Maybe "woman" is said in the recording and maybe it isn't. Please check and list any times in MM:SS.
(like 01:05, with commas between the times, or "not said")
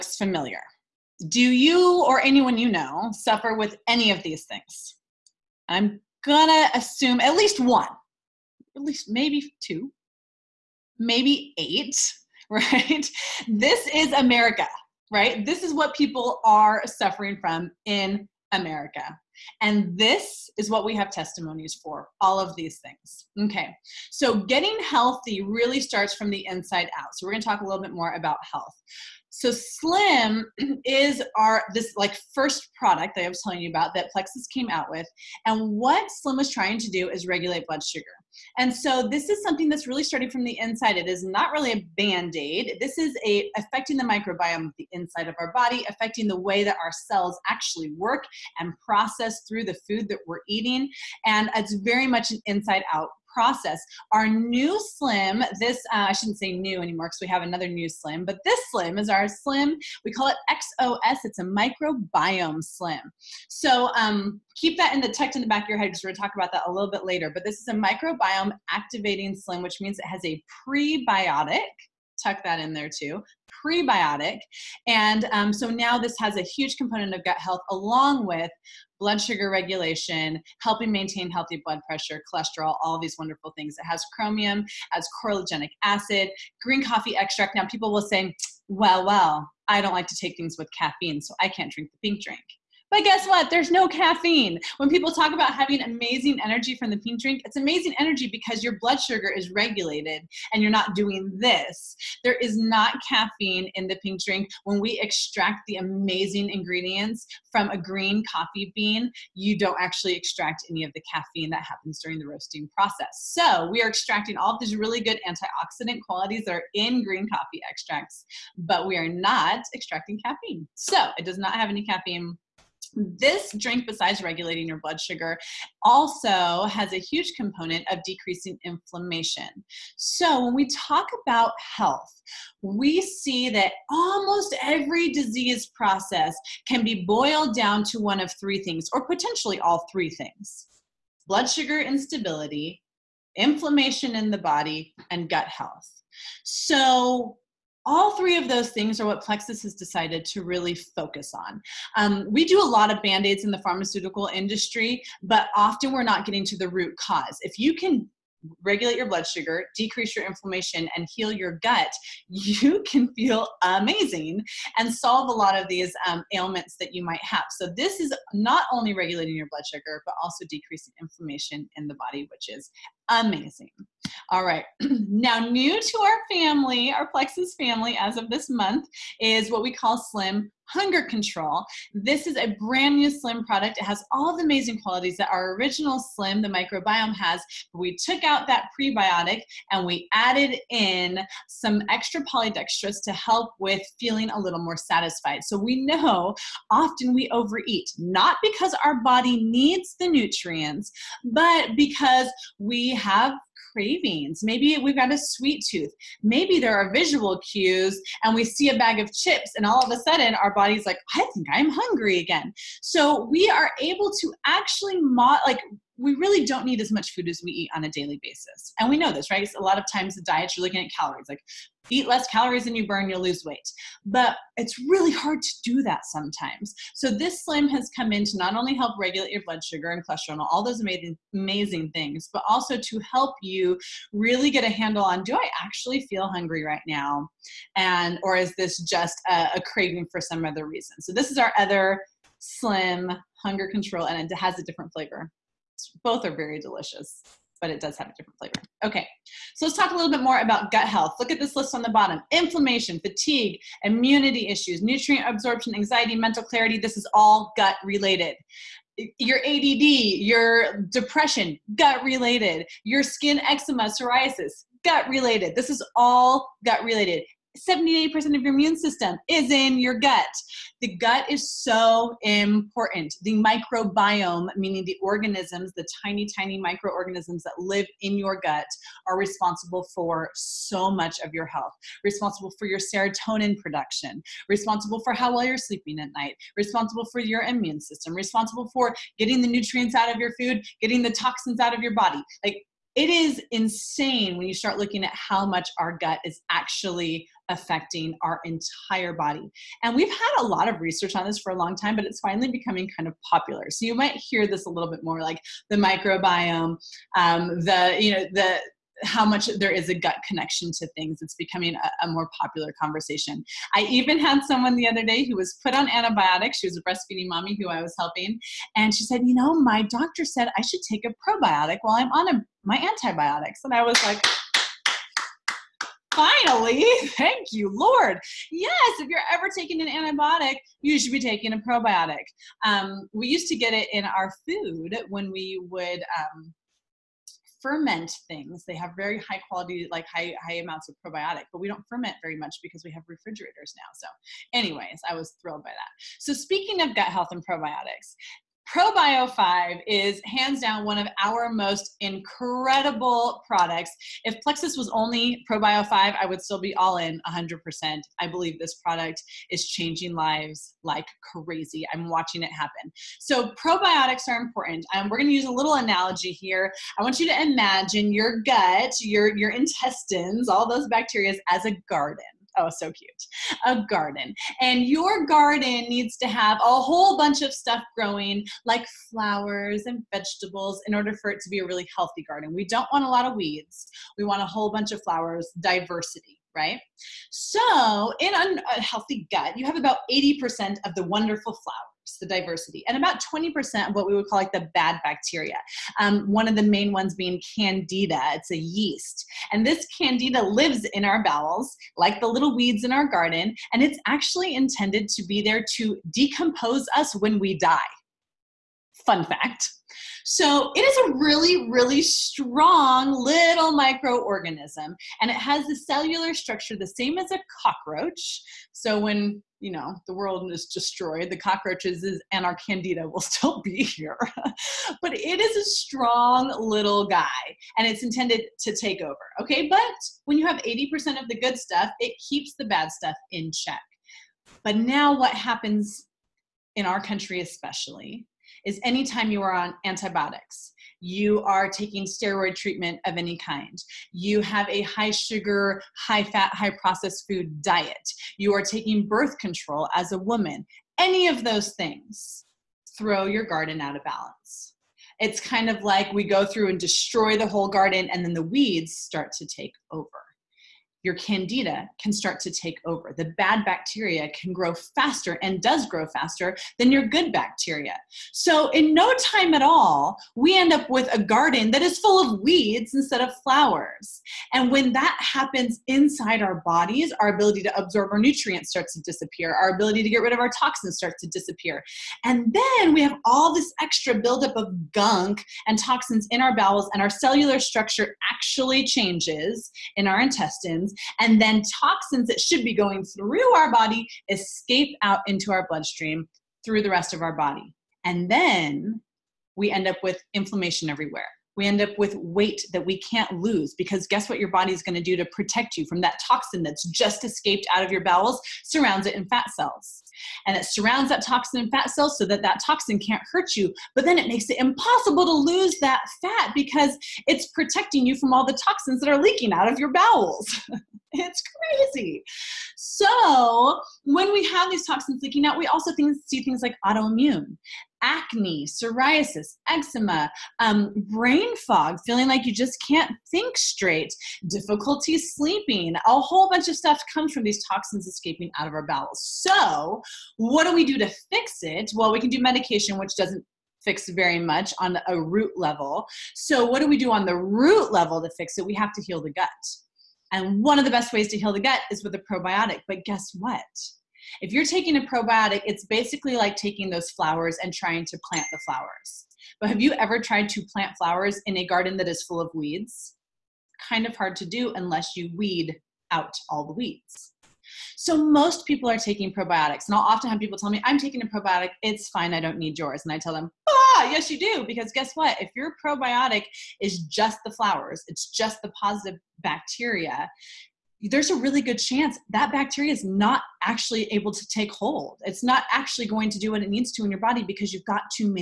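07:30.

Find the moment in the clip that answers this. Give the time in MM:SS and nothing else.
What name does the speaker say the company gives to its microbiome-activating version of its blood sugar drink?
01:00.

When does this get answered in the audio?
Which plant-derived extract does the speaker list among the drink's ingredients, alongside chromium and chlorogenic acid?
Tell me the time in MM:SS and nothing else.
01:26.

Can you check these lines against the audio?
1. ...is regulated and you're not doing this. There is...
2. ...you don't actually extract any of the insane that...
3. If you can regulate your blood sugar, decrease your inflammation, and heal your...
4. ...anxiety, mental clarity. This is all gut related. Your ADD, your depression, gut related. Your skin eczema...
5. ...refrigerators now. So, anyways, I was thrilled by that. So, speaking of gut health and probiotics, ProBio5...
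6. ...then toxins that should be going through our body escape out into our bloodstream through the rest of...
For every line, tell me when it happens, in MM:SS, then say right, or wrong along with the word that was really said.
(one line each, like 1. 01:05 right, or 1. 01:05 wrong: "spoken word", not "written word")
1. 01:39 right
2. 01:49 wrong: "caffeine", not "insane"
3. 02:37 right
4. 04:15 right
5. 05:43 right
6. 08:11 right.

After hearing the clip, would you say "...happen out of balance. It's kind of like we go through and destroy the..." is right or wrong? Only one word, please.
wrong.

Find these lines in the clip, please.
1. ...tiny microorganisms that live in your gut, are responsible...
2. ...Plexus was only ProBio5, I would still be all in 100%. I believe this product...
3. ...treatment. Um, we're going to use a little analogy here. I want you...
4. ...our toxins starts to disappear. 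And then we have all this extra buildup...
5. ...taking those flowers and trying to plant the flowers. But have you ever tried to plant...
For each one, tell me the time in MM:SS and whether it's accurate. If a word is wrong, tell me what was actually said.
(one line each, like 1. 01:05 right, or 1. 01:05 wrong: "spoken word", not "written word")
1. 04:36 right
2. 05:54 right
3. 06:04 wrong: "important", not "treatment"
4. 08:00 right
5. 09:16 right.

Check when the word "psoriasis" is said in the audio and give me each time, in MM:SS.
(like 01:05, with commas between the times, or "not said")
04:23, 08:48.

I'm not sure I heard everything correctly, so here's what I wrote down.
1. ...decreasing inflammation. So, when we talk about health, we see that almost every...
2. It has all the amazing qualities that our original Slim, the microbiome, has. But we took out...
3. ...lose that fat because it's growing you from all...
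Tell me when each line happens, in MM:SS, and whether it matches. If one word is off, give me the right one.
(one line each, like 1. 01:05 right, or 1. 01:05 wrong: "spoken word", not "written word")
1. 02:08 right
2. 03:03 right
3. 08:35 wrong: "protecting", not "growing".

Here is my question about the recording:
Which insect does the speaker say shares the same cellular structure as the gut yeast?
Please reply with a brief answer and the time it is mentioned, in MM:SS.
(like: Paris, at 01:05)
cockroach, at 06:57.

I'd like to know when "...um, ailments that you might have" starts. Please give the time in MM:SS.
02:46.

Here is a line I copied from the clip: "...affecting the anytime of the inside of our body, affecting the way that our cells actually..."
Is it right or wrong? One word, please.
wrong.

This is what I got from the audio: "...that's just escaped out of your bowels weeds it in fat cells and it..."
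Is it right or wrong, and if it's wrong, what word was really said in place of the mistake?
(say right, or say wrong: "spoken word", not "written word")
wrong: "surrounds", not "weeds".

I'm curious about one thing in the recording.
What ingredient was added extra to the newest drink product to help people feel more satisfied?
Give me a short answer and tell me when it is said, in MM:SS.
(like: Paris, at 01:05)
polydextrose, at 03:12.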